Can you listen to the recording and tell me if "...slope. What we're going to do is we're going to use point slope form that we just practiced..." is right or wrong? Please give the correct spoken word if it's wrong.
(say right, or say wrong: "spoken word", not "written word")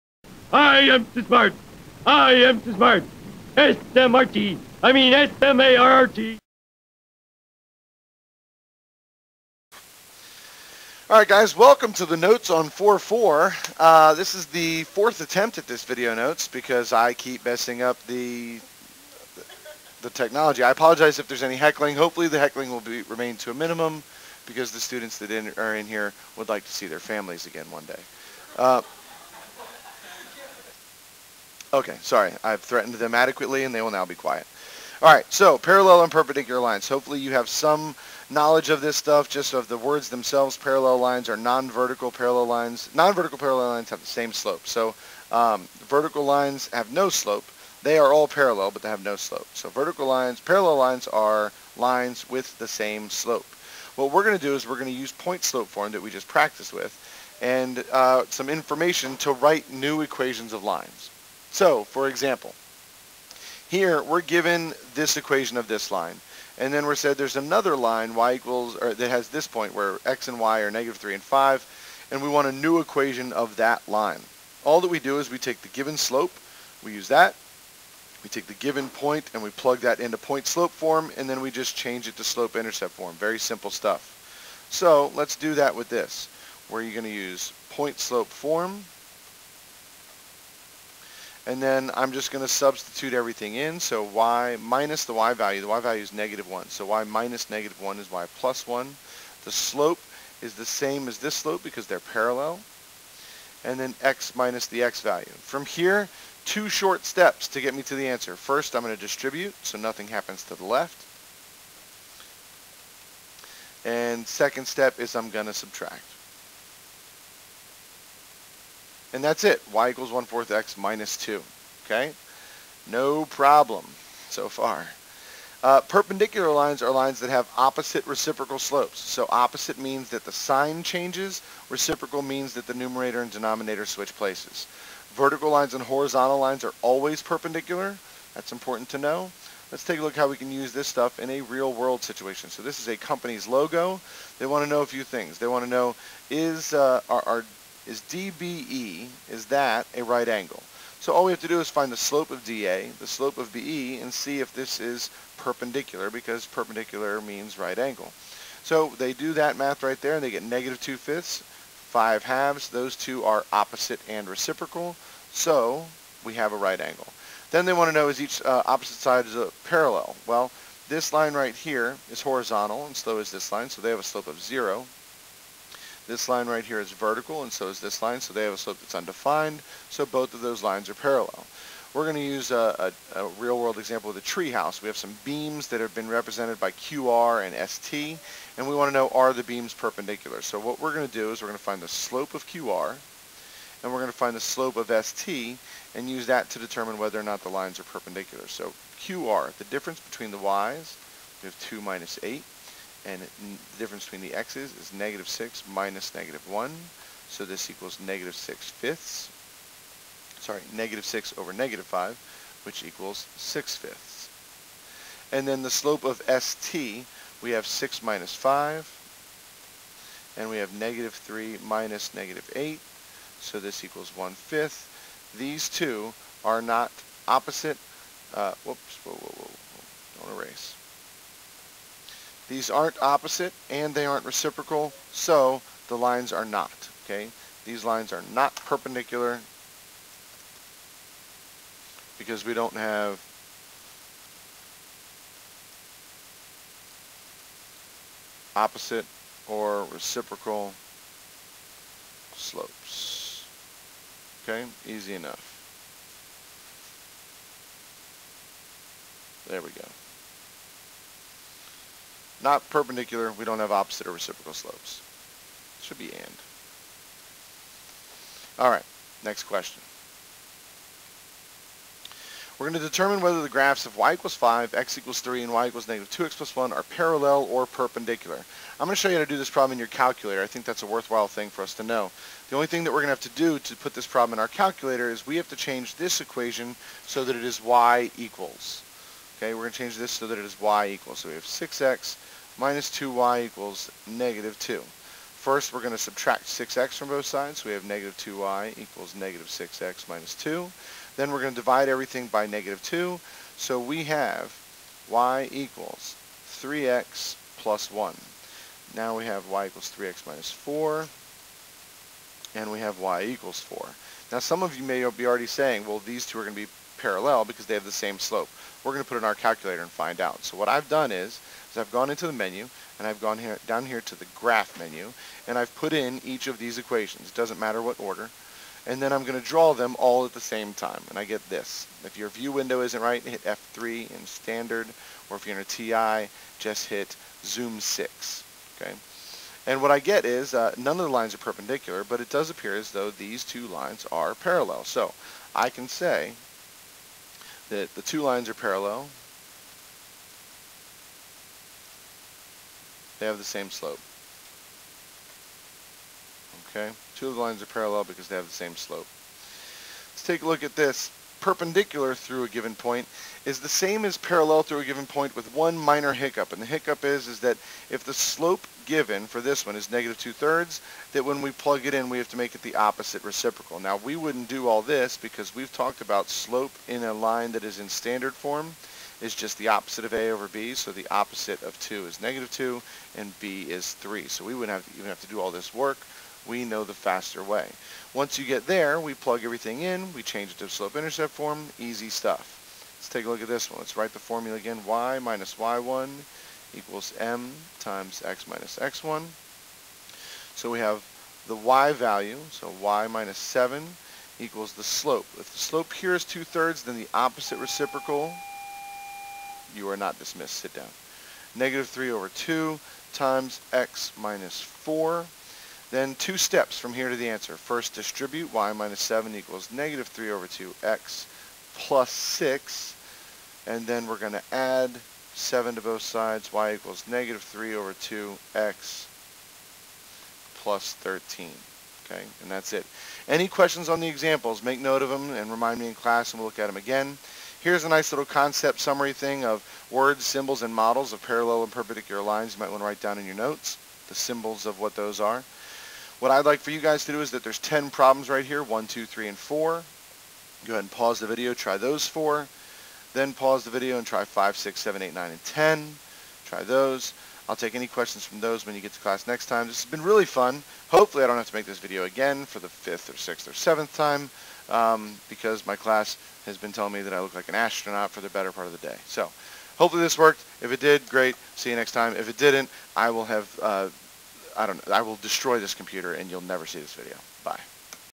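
right.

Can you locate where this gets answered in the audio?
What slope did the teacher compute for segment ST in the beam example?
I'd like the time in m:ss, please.
3:44.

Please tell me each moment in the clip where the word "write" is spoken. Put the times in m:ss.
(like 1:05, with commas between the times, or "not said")
0:59, 6:33, 7:22.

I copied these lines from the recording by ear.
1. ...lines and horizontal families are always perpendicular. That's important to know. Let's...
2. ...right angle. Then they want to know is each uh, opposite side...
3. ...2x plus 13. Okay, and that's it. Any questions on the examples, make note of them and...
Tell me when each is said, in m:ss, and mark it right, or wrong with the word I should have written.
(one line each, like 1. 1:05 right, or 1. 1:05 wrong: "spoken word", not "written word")
1. 2:15 wrong: "lines", not "families"
2. 2:46 right
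3. 7:07 right.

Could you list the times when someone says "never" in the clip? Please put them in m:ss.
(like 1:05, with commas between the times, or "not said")
7:56.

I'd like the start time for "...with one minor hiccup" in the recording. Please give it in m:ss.
6:05.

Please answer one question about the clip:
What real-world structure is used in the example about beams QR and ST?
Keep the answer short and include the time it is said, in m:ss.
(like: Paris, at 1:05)
treehouse, at 3:04.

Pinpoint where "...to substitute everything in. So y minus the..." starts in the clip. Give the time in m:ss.
1:32.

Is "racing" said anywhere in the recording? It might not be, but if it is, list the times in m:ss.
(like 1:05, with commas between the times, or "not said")
not said.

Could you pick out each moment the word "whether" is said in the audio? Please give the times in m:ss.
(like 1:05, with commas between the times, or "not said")
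3:16, 4:33.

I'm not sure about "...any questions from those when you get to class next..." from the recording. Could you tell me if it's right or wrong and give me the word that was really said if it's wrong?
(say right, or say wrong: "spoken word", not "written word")
right.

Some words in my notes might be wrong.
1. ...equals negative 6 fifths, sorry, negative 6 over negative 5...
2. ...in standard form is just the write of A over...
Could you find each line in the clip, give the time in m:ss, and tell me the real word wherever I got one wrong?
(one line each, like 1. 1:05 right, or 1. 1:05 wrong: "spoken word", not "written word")
1. 3:27 right
2. 6:17 wrong: "opposite", not "write".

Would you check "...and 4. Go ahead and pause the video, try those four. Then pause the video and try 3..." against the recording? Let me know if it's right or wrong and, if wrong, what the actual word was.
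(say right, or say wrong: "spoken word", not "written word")
wrong: "5", not "3".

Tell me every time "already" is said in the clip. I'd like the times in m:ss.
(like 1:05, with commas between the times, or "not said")
5:15.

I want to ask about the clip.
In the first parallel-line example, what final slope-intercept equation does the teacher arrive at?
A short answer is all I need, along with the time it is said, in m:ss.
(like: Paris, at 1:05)
y = 1/4x - 2, at 1:59.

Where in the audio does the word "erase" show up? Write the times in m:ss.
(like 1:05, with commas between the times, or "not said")
3:50.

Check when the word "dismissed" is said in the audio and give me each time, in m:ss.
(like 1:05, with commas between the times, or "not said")
6:50.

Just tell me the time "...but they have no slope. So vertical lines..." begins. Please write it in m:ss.
0:48.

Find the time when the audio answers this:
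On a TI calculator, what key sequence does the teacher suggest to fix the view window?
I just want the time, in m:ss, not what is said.
5:37.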